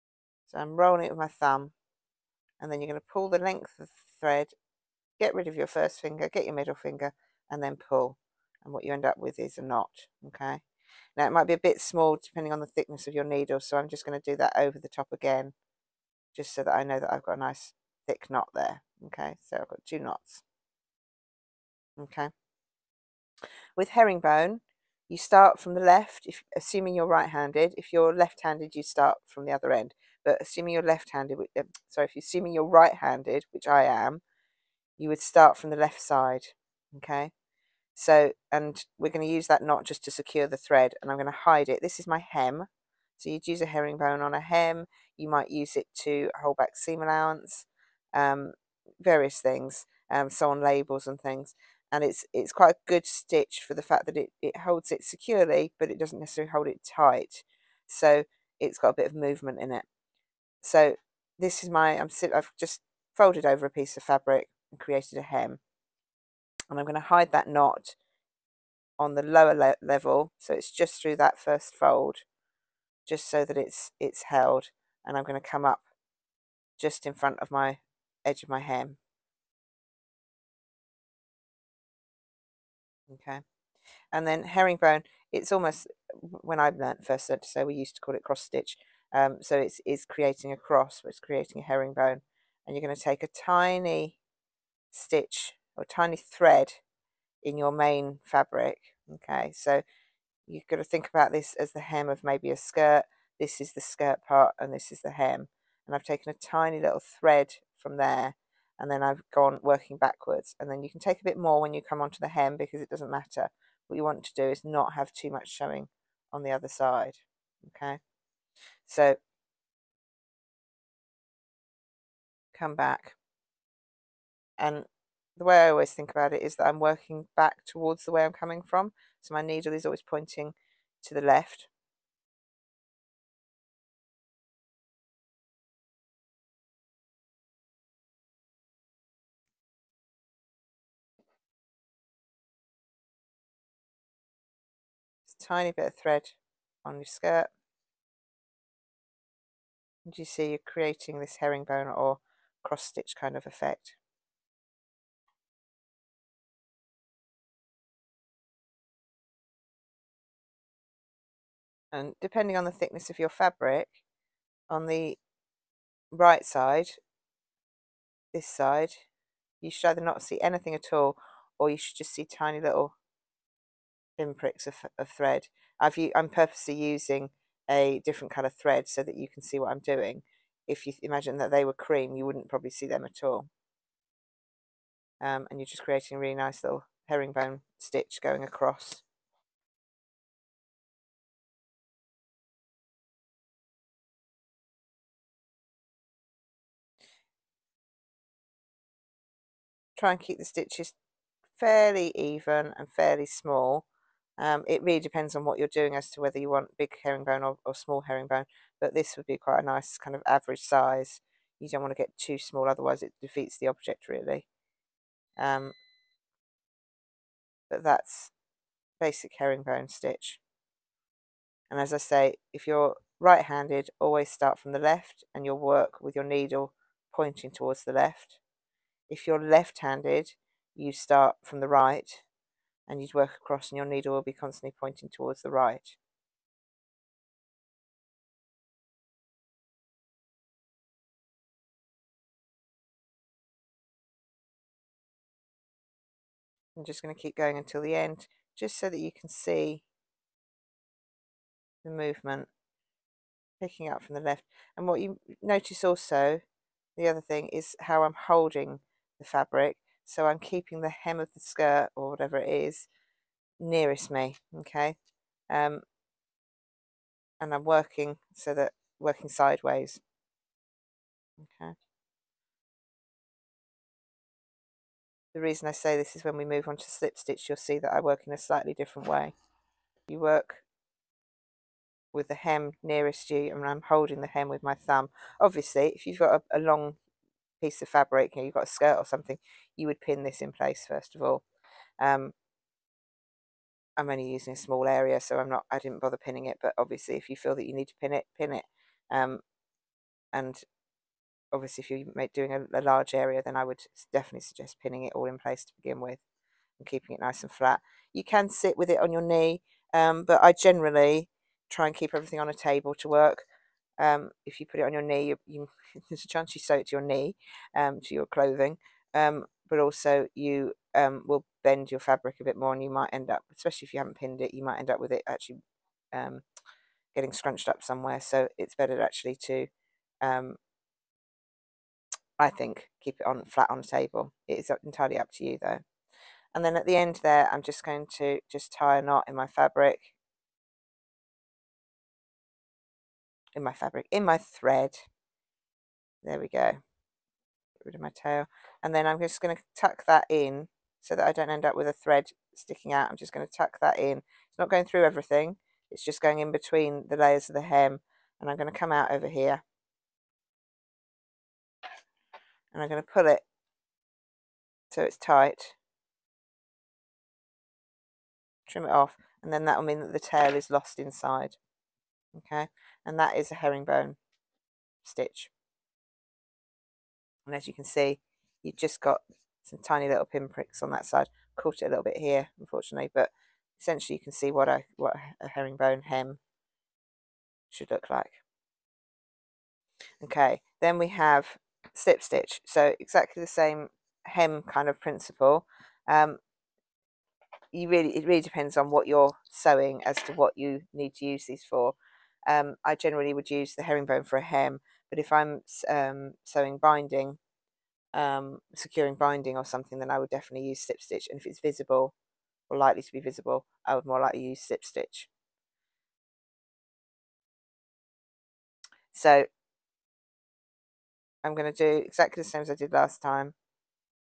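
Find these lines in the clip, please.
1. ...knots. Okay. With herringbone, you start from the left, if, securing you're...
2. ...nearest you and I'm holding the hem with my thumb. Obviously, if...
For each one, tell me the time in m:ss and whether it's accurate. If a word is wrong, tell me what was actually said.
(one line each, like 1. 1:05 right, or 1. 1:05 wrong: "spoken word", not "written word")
1. 0:19 wrong: "assuming", not "securing"
2. 4:42 right.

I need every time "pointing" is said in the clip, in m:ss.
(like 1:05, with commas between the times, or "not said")
2:10, 3:47, 3:54.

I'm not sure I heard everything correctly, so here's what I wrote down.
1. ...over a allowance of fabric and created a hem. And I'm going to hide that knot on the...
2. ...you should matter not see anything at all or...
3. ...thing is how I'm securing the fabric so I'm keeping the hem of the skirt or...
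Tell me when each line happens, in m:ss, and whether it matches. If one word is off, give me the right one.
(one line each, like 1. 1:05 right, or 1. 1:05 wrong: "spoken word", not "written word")
1. 1:03 wrong: "piece", not "allowance"
2. 2:49 wrong: "either", not "matter"
3. 4:17 wrong: "holding", not "securing".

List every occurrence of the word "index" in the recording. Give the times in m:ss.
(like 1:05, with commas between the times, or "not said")
not said.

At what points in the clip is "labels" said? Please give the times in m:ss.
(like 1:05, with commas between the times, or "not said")
0:50.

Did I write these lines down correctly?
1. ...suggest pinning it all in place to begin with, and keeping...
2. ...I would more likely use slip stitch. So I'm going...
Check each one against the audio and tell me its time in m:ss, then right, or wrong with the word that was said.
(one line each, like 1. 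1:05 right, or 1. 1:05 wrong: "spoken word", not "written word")
1. 5:04 right
2. 6:53 right.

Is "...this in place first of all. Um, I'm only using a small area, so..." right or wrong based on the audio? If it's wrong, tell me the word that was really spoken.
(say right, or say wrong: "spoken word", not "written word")
right.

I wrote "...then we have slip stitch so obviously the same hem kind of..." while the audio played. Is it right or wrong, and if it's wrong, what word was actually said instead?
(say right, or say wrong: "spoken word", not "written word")
wrong: "exactly", not "obviously".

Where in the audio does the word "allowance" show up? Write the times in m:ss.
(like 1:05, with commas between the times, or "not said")
0:47.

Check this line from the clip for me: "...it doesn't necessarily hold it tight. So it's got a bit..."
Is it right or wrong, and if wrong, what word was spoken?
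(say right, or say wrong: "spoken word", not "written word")
right.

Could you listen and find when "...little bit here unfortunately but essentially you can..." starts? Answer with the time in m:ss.
6:21.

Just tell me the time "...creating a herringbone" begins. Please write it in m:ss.
1:31.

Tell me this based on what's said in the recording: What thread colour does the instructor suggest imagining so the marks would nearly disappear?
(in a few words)
cream.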